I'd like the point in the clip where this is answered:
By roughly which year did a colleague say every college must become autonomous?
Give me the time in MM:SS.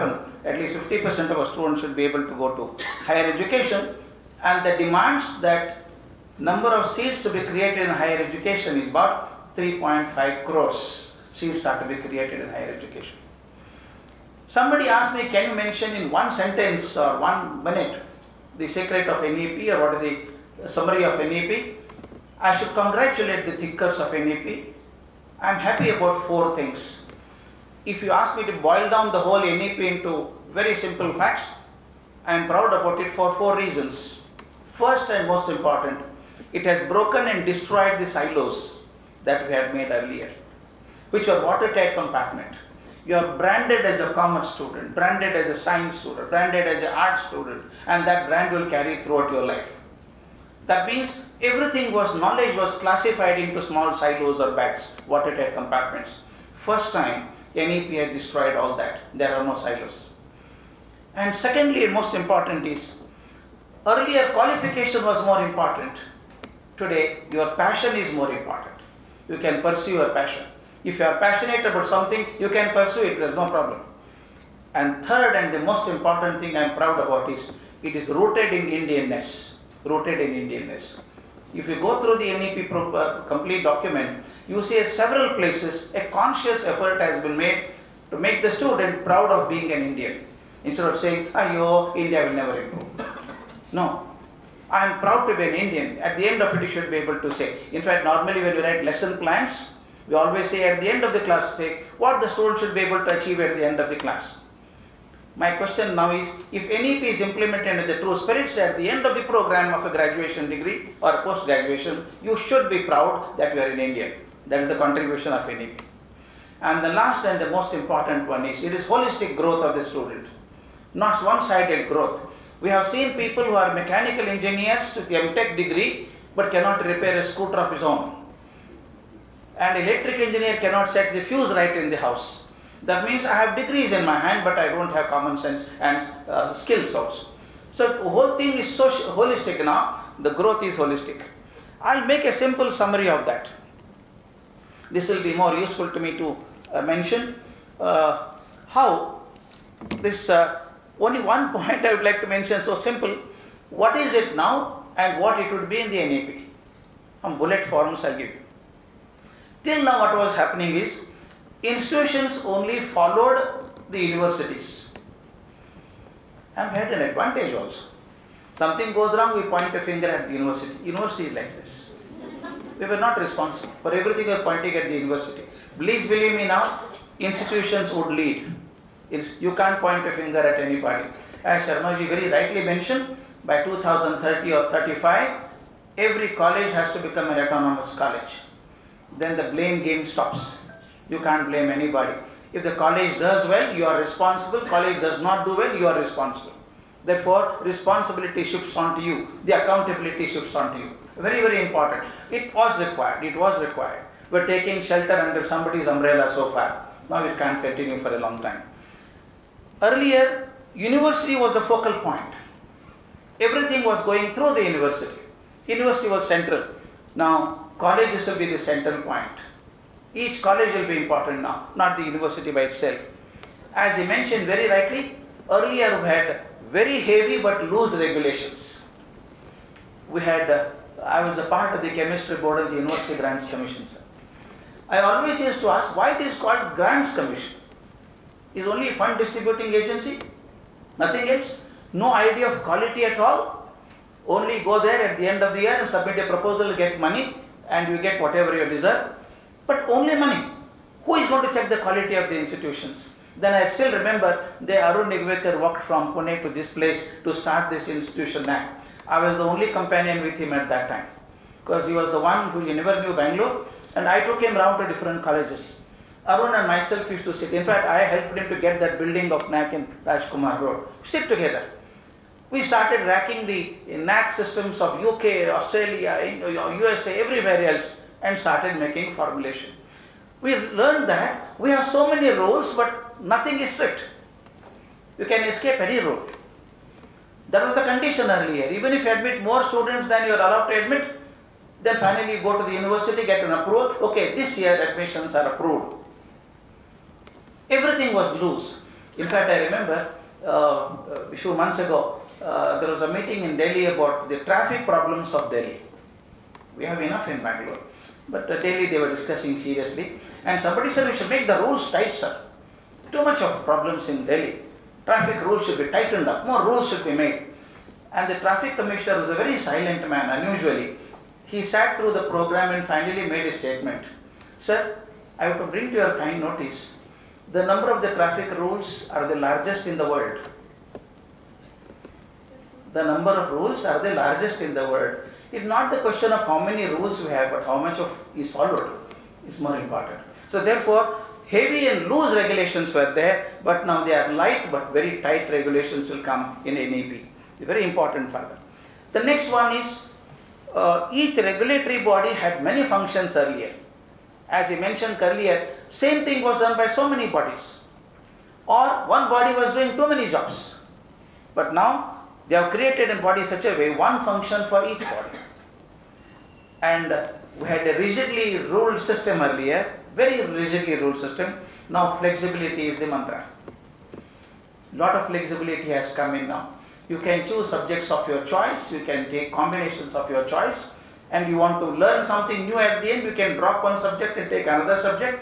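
03:03.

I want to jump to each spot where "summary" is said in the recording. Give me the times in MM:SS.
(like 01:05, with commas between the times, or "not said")
00:20, 02:22.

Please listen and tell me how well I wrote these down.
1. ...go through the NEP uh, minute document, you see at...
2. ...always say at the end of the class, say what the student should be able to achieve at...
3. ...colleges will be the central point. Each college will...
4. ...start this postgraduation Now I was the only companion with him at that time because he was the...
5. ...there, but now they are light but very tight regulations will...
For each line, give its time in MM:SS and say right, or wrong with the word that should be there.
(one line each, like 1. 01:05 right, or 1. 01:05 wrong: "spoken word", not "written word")
1. 01:21 wrong: "complete", not "minute"
2. 01:40 right
3. 03:37 right
4. 04:17 wrong: "institution", not "postgraduation"
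5. 05:43 right.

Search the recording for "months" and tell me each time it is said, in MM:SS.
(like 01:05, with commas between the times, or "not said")
05:01.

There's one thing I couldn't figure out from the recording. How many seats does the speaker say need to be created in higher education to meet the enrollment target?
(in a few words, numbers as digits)
3.5 crores.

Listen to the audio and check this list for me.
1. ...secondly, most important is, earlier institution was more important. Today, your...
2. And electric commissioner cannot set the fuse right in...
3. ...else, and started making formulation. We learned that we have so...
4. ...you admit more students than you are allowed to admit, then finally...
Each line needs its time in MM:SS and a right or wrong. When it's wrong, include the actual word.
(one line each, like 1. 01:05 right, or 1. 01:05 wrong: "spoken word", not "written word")
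1. 01:01 wrong: "qualification", not "institution"
2. 02:09 wrong: "engineer", not "commissioner"
3. 04:37 right
4. 04:49 right.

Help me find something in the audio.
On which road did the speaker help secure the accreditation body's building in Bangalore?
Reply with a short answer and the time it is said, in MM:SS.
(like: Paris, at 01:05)
Rajkumar Road, at 04:30.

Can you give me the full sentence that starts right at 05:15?
Traffic rules should be tightened up.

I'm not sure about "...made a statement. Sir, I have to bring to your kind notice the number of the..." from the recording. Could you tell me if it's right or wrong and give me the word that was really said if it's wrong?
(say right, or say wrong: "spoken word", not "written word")
right.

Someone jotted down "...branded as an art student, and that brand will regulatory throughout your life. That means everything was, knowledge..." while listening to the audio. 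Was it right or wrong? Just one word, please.
wrong.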